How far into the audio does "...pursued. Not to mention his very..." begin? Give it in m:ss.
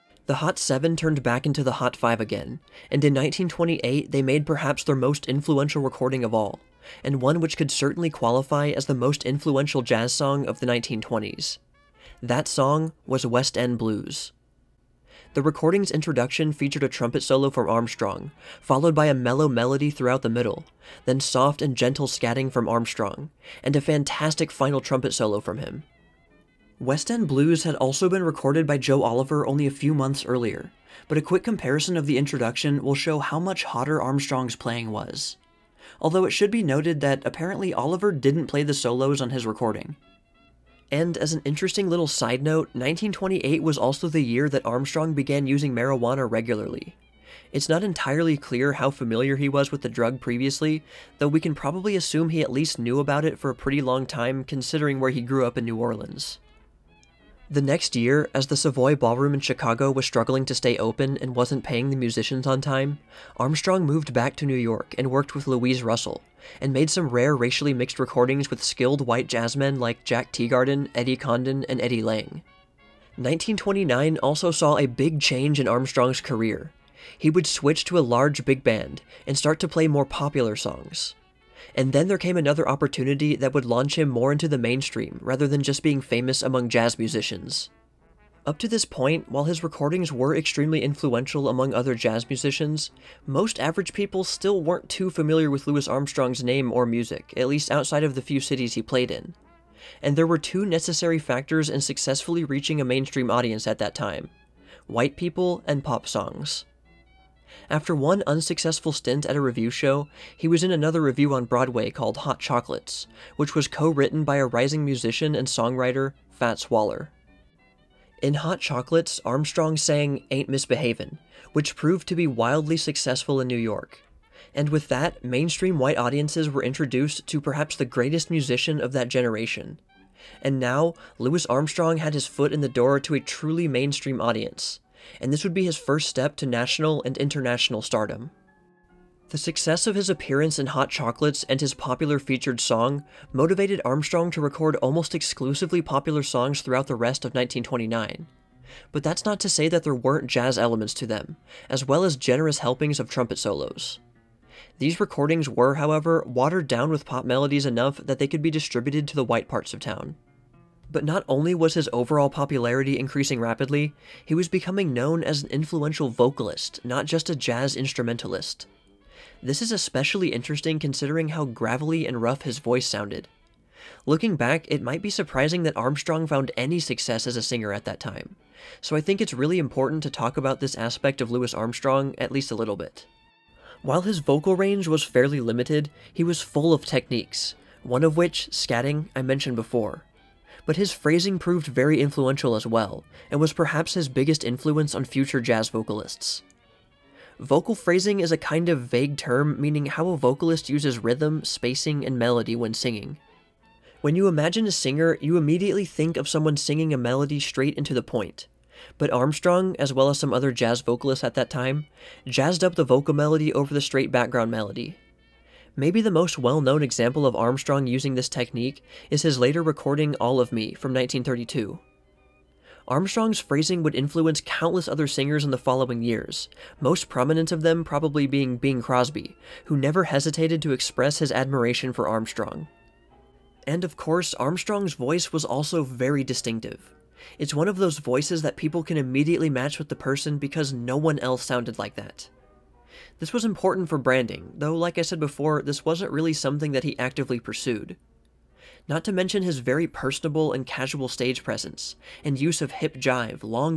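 4:07.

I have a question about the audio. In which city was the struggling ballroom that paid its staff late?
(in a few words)
Chicago.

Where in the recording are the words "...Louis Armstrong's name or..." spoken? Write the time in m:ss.
1:35.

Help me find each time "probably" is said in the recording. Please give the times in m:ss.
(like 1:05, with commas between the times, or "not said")
0:51, 3:47.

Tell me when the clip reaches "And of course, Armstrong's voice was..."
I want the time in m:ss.
3:53.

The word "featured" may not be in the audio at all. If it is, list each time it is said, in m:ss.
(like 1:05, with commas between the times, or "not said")
0:16, 2:22.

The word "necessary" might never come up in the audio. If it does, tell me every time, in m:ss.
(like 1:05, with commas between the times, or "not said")
1:40.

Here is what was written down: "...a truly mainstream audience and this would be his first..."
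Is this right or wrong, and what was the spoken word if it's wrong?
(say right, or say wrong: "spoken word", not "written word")
right.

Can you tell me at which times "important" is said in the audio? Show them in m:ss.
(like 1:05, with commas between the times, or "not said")
2:59, 4:03.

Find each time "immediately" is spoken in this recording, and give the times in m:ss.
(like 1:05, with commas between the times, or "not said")
3:25, 3:58.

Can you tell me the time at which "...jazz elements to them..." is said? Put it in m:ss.
2:30.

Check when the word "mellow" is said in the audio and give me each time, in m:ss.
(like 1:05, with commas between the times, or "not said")
0:19.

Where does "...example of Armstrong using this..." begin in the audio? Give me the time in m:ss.
3:36.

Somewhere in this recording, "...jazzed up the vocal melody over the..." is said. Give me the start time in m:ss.
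3:32.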